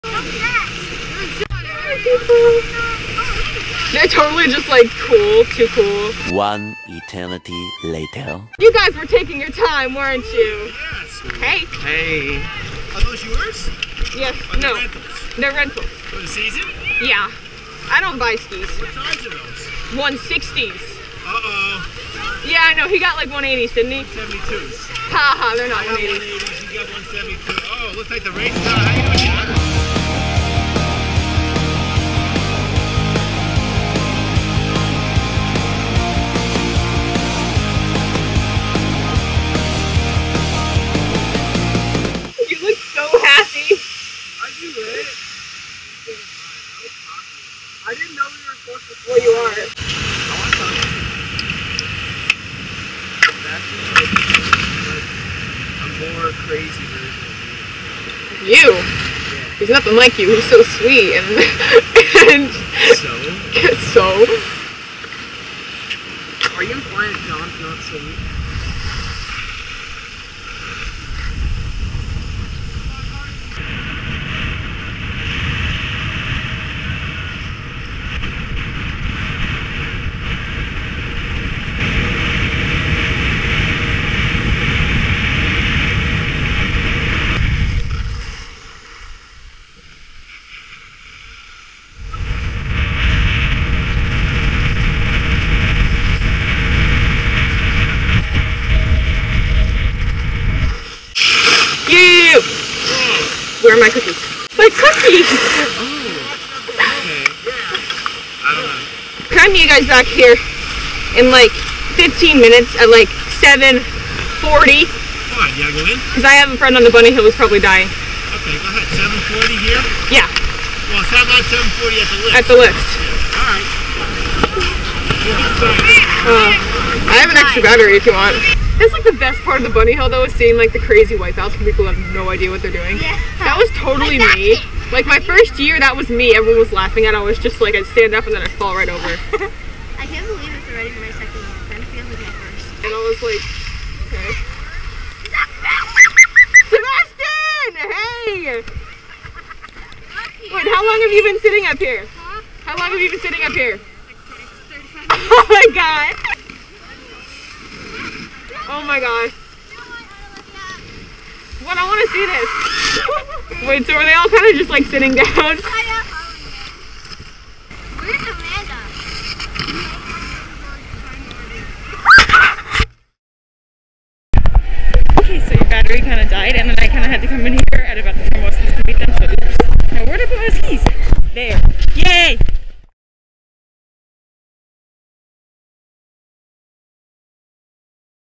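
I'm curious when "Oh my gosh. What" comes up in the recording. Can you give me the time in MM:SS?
02:38.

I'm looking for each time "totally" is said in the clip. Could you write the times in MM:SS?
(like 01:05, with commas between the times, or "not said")
00:04, 02:13.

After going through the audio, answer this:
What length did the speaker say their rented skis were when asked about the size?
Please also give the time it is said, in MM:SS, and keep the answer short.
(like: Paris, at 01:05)
160, at 00:19.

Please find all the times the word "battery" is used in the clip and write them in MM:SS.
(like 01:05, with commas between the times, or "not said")
02:07, 02:55.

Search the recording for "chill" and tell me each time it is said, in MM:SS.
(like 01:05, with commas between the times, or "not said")
not said.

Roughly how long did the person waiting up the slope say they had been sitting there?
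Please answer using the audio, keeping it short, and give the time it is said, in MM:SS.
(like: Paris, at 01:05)
30 to 35 minutes, at 02:34.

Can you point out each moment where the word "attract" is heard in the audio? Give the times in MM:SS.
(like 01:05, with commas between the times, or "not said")
not said.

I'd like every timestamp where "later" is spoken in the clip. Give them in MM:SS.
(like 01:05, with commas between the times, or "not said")
00:07.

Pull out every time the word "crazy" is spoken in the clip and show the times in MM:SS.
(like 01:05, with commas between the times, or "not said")
00:56, 02:10.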